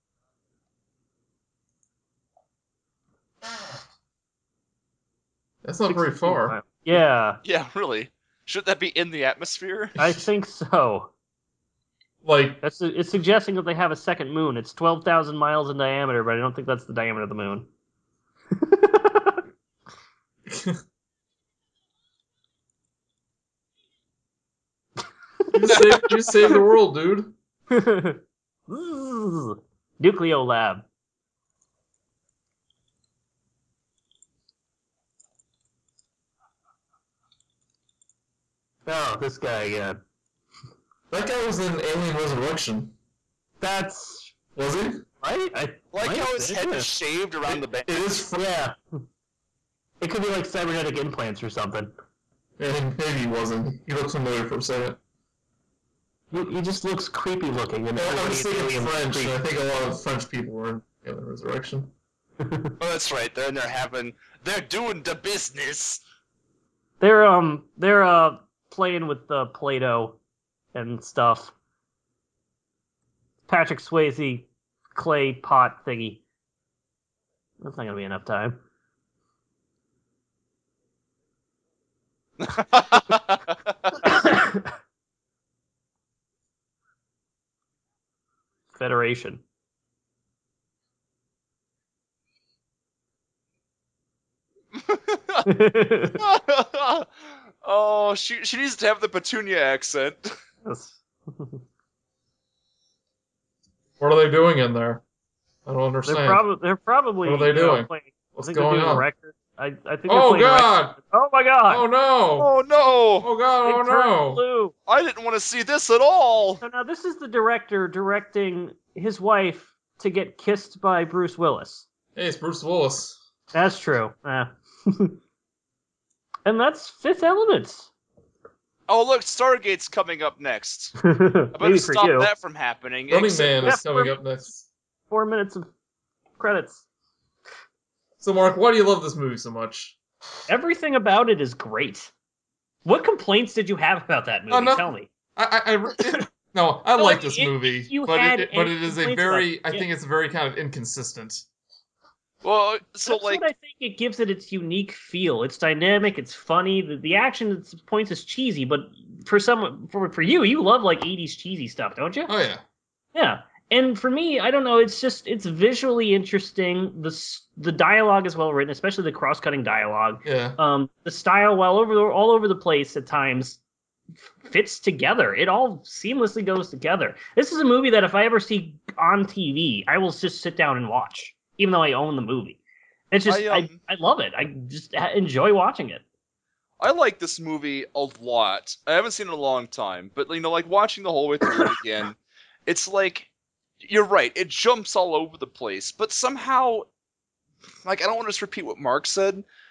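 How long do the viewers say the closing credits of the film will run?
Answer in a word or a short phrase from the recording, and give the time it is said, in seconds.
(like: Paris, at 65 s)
4 minutes, at 135 s.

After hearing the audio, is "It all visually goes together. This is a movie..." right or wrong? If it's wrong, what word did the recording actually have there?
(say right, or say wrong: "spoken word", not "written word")
wrong: "seamlessly", not "visually".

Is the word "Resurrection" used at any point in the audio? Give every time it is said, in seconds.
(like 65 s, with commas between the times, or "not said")
42 s, 61 s.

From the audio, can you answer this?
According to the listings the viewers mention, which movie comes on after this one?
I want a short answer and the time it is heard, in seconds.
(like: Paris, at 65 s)
Stargate, at 129 s.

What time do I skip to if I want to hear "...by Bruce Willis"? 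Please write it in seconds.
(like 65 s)
120 s.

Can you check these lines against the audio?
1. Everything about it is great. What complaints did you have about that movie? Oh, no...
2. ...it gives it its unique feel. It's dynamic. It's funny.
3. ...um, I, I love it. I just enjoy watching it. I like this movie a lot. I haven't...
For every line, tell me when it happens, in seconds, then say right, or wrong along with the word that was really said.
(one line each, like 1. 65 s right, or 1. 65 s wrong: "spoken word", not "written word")
1. 140 s right
2. 153 s right
3. 183 s right.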